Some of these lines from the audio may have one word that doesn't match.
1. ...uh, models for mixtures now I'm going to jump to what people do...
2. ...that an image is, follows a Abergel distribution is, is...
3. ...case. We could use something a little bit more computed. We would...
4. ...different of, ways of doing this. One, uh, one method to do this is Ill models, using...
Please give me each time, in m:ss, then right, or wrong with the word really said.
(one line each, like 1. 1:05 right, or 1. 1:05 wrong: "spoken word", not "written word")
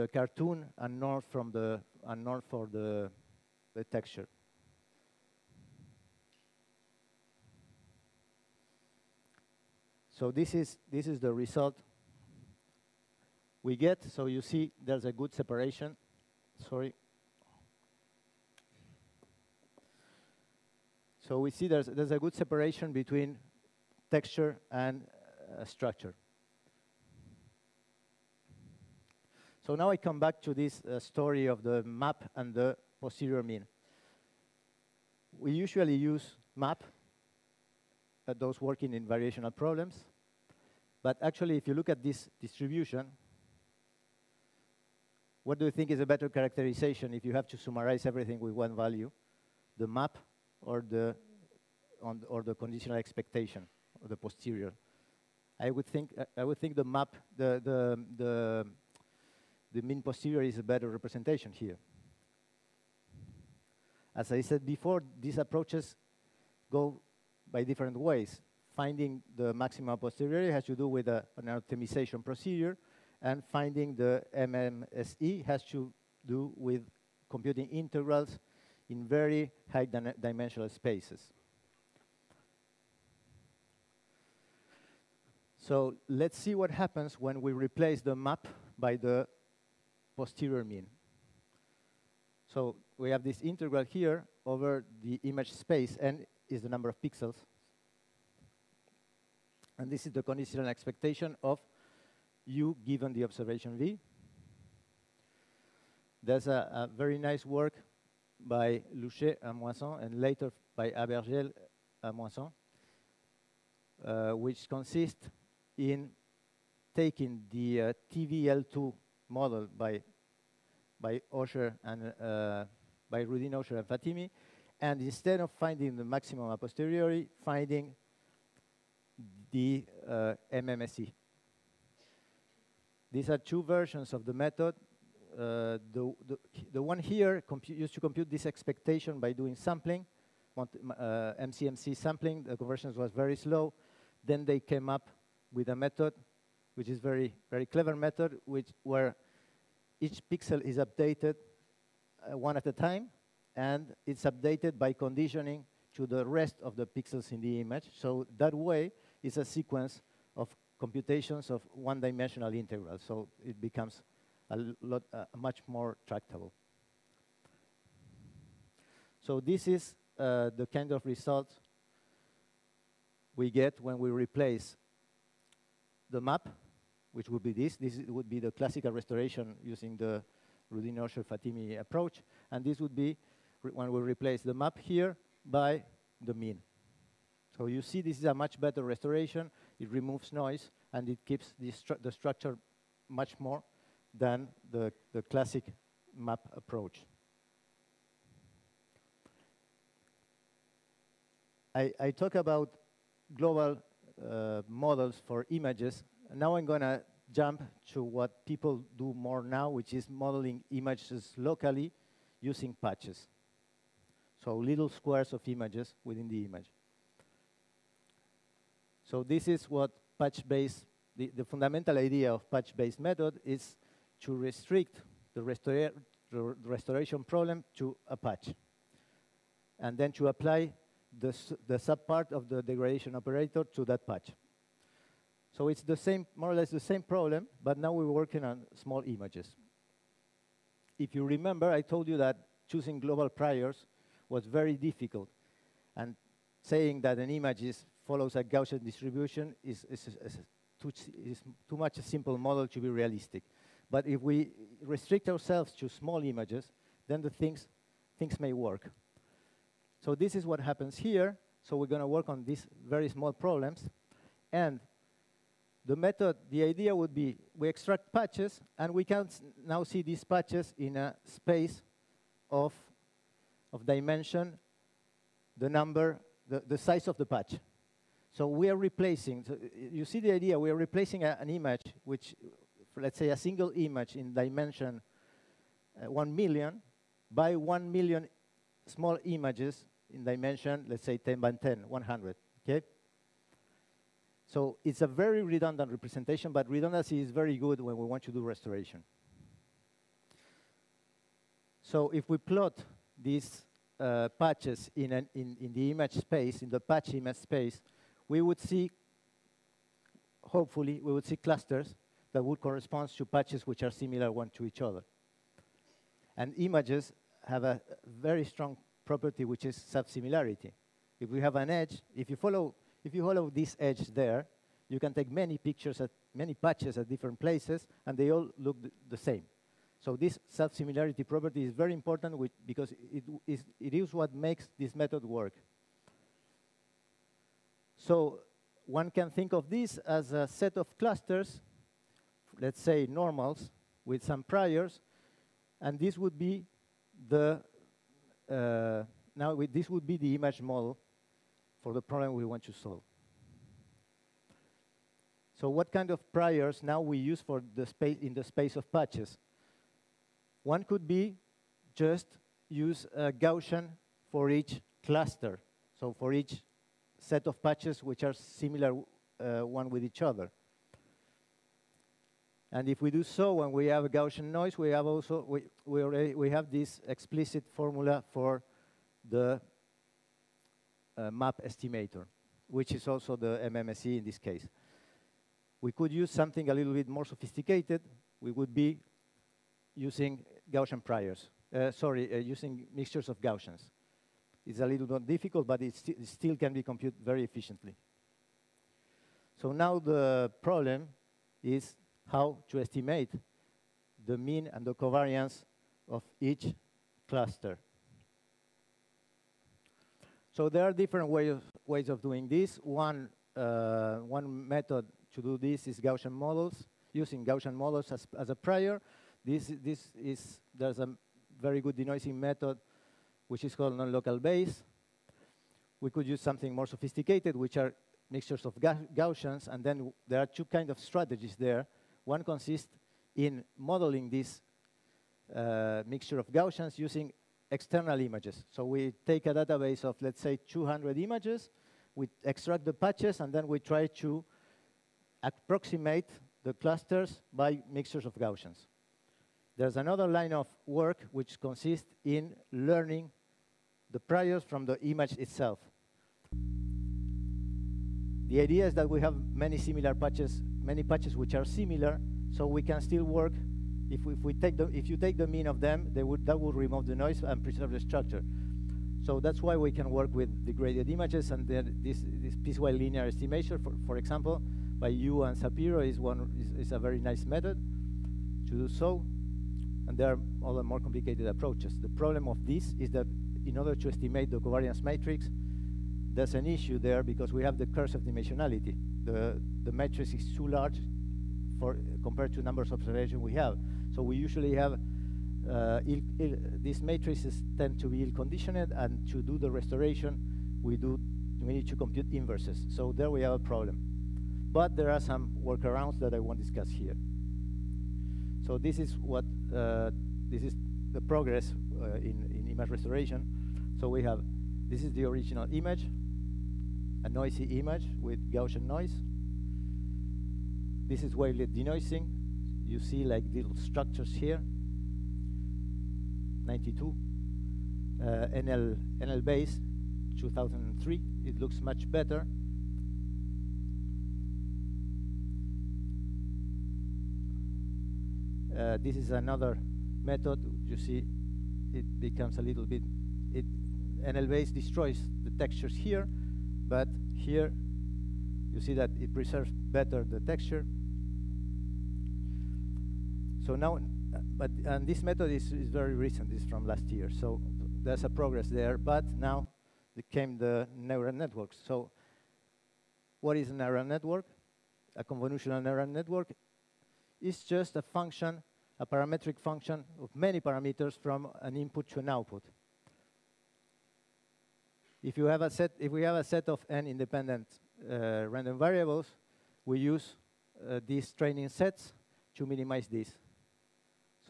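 1. 3:24 wrong: "images", not "mixtures"
2. 4:07 wrong: "Gaussian", not "Abergel"
3. 6:24 wrong: "sophisticated", not "computed"
4. 6:50 wrong: "Gaussian", not "Ill".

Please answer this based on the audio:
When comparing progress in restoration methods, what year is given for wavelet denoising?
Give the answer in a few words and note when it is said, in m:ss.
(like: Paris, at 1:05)
1992, at 8:46.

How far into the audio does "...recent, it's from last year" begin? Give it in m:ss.
9:16.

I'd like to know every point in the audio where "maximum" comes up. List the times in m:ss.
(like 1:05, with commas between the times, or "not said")
1:09, 2:06.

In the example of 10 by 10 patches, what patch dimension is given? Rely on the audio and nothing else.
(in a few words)
100.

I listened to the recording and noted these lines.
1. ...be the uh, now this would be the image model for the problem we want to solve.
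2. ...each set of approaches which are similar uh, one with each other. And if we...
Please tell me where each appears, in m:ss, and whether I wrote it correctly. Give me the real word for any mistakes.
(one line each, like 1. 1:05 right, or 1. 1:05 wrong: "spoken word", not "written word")
1. 5:46 right
2. 6:06 wrong: "patches", not "approaches".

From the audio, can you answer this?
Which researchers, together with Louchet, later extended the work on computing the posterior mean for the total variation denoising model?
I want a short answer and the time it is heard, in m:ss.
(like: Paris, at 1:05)
Abergel and Moisan, at 1:50.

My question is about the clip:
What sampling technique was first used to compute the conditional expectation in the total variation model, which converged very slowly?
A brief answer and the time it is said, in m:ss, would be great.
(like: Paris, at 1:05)
MCMC sampling, at 2:21.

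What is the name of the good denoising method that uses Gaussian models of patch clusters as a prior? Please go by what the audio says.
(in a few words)
Non-local Bayes.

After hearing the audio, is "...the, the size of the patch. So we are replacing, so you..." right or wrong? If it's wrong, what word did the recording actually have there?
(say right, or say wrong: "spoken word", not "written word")
right.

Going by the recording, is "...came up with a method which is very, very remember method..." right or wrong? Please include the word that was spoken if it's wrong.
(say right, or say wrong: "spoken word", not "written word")
wrong: "clever", not "remember".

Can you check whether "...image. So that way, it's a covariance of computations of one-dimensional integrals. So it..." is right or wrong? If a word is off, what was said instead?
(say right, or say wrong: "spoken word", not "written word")
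wrong: "sequence", not "covariance".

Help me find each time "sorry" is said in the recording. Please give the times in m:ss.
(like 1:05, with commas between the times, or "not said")
0:16, 6:31.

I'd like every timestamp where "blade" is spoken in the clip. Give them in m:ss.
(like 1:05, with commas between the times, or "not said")
not said.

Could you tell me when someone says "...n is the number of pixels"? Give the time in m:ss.
1:35.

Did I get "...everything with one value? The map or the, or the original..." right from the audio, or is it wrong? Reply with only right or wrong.
wrong.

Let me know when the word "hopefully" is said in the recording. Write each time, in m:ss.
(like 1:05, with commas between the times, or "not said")
5:10.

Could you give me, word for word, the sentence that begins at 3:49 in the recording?
And then to apply the, the subpart of the degradation operator to that patch.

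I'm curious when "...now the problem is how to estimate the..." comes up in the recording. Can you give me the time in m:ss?
6:39.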